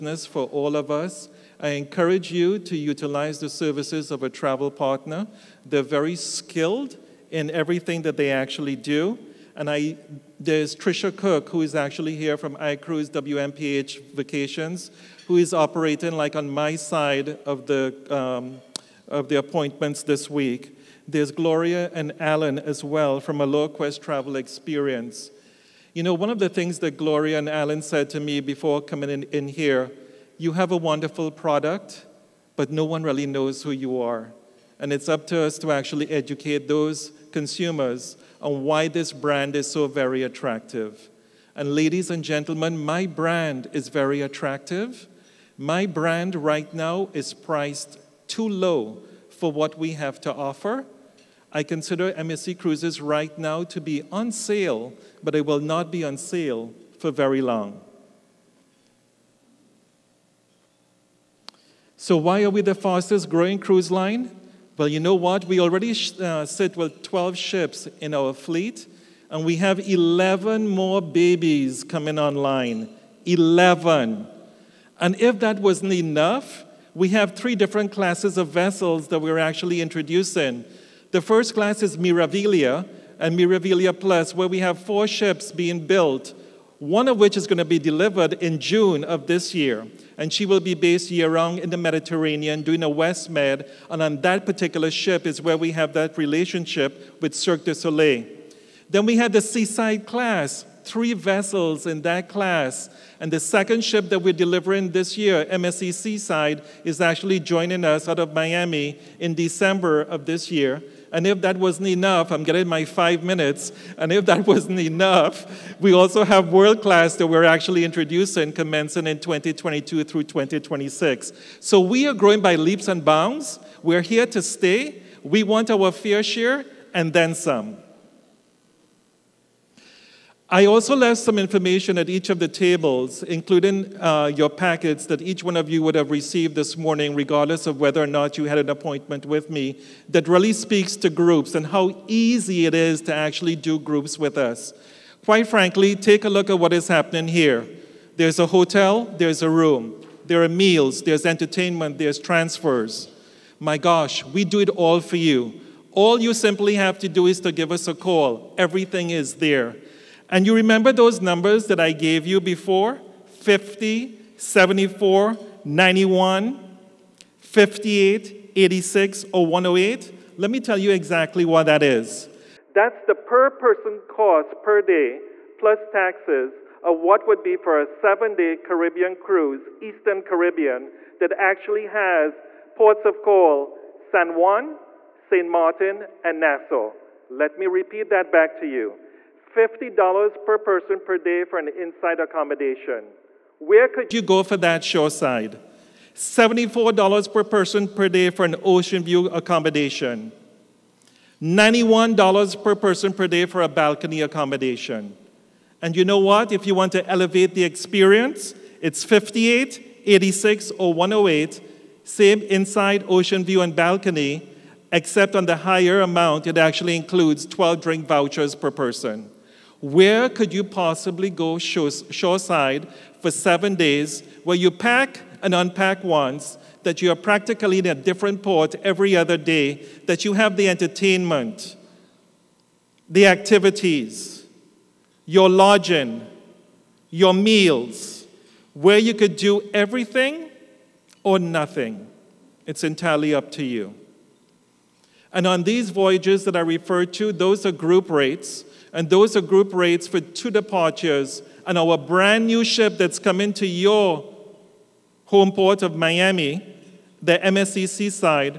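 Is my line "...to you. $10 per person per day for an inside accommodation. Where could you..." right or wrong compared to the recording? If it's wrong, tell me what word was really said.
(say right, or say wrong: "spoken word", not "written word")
wrong: "50", not "10".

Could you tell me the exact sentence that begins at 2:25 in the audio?
Quite frankly, take a look at what is happening here.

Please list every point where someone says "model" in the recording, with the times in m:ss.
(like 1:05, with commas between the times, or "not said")
not said.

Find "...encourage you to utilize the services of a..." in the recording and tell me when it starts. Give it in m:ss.
0:01.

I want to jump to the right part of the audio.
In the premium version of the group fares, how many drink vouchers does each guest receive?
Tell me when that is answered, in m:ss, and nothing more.
3:37.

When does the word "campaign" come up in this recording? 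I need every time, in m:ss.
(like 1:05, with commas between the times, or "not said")
not said.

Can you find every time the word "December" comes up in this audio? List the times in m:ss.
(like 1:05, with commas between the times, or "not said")
1:49.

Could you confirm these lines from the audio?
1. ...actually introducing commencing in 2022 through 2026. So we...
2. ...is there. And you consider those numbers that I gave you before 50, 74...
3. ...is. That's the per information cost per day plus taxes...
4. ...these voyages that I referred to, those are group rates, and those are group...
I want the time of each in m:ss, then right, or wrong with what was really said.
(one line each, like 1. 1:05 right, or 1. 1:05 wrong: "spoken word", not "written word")
1. 1:57 right
2. 2:39 wrong: "remember", not "consider"
3. 2:51 wrong: "person", not "information"
4. 4:05 right.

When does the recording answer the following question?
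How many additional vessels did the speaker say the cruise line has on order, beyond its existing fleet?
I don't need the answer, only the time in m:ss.
1:09.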